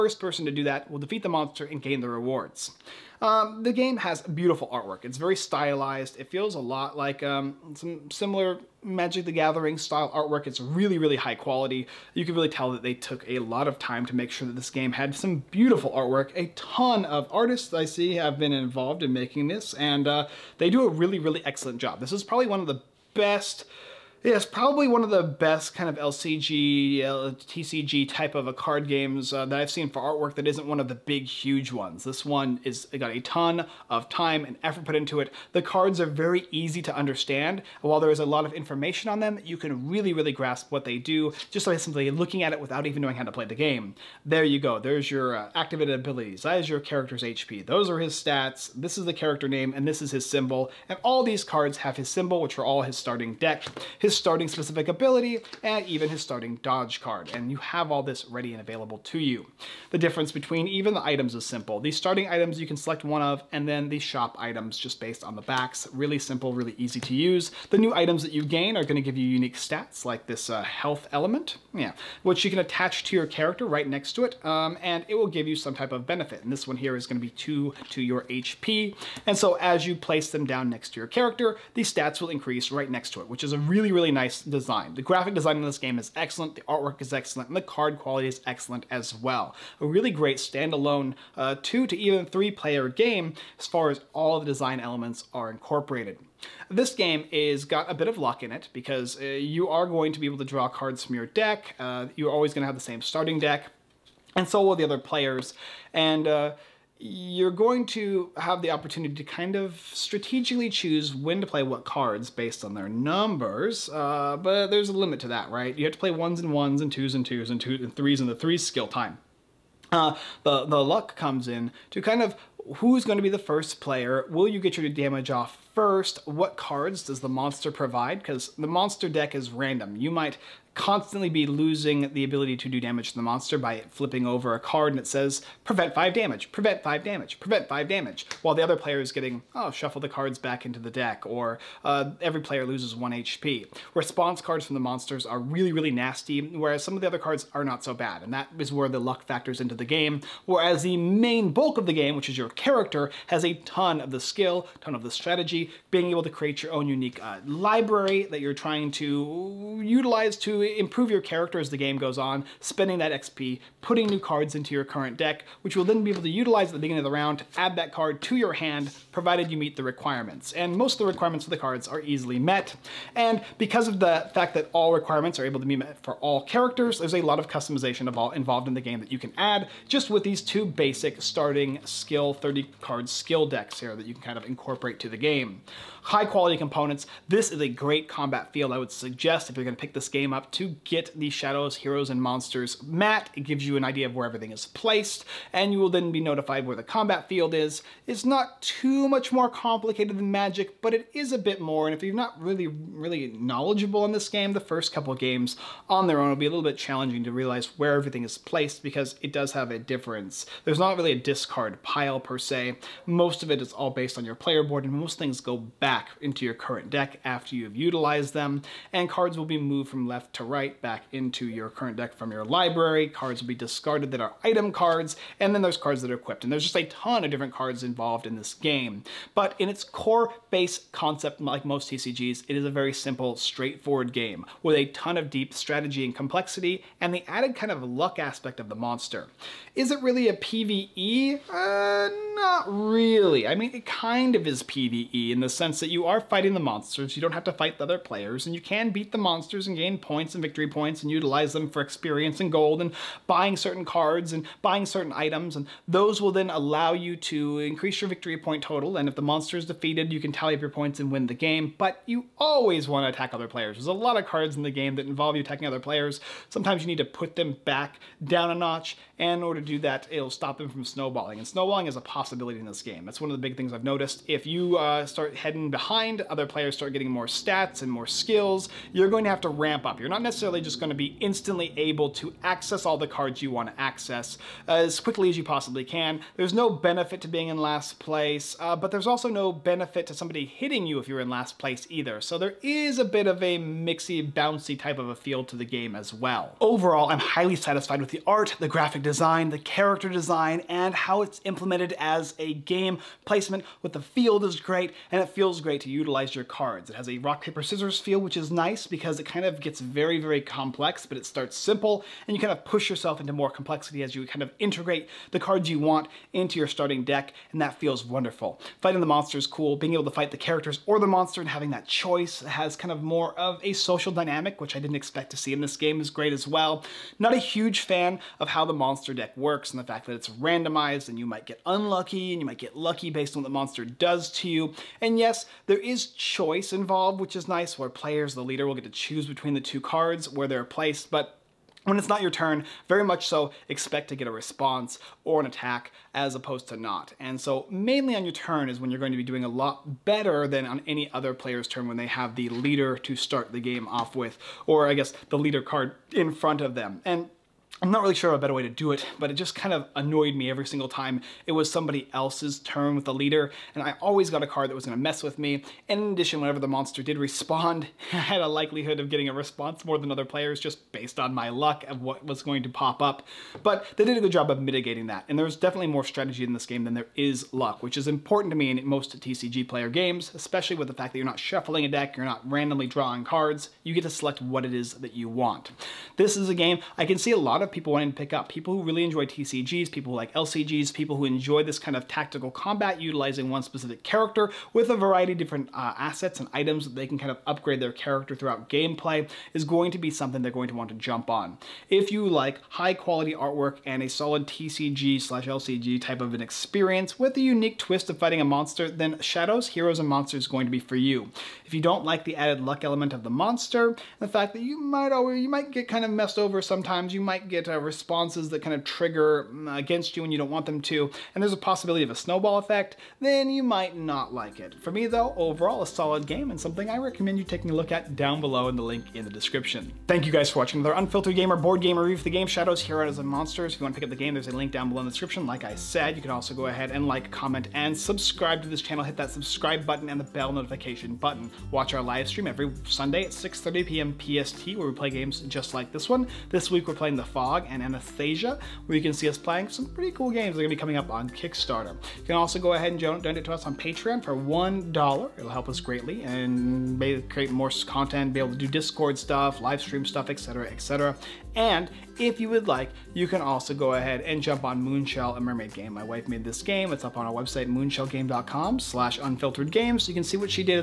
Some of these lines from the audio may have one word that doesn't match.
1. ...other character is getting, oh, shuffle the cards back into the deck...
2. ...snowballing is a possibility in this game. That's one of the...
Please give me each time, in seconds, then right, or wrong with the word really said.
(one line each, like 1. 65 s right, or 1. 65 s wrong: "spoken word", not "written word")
1. 138 s wrong: "player", not "character"
2. 271 s right.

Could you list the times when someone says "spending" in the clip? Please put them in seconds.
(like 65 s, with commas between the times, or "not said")
162 s.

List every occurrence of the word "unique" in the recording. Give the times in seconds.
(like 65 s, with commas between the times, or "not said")
69 s, 156 s, 407 s.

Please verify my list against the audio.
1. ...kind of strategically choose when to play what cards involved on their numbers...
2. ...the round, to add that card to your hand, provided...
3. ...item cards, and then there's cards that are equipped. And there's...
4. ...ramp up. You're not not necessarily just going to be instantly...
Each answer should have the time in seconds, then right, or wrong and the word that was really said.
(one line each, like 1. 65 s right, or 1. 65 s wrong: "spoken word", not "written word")
1. 109 s wrong: "based", not "involved"
2. 167 s right
3. 224 s right
4. 279 s right.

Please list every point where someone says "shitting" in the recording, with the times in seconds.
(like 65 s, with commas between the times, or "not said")
not said.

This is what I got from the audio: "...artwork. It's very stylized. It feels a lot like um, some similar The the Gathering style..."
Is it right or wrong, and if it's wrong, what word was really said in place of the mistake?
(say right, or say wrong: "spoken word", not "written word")
wrong: "Magic", not "The".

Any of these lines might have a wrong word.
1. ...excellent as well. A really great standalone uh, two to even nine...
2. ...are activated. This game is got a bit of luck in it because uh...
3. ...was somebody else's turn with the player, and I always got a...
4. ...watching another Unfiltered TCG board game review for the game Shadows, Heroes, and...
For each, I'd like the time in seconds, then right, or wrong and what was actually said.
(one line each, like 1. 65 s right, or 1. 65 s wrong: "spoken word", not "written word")
1. 88 s wrong: "three", not "nine"
2. 95 s wrong: "incorporated", not "activated"
3. 361 s wrong: "leader", not "player"
4. 430 s wrong: "Gamer", not "TCG".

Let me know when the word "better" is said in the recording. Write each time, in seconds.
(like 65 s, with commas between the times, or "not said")
350 s, 358 s.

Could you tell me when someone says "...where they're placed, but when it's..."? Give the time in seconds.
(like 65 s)
340 s.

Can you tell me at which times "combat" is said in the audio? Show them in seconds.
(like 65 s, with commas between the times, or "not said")
188 s, 196 s, 392 s.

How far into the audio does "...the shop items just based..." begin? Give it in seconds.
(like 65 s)
63 s.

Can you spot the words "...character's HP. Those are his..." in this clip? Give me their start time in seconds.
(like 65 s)
46 s.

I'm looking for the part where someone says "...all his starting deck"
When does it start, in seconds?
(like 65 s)
52 s.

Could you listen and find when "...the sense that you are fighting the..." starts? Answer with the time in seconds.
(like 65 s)
245 s.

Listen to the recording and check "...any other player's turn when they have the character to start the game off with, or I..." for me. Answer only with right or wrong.
wrong.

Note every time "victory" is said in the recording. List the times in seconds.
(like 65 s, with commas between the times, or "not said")
250 s, 258 s.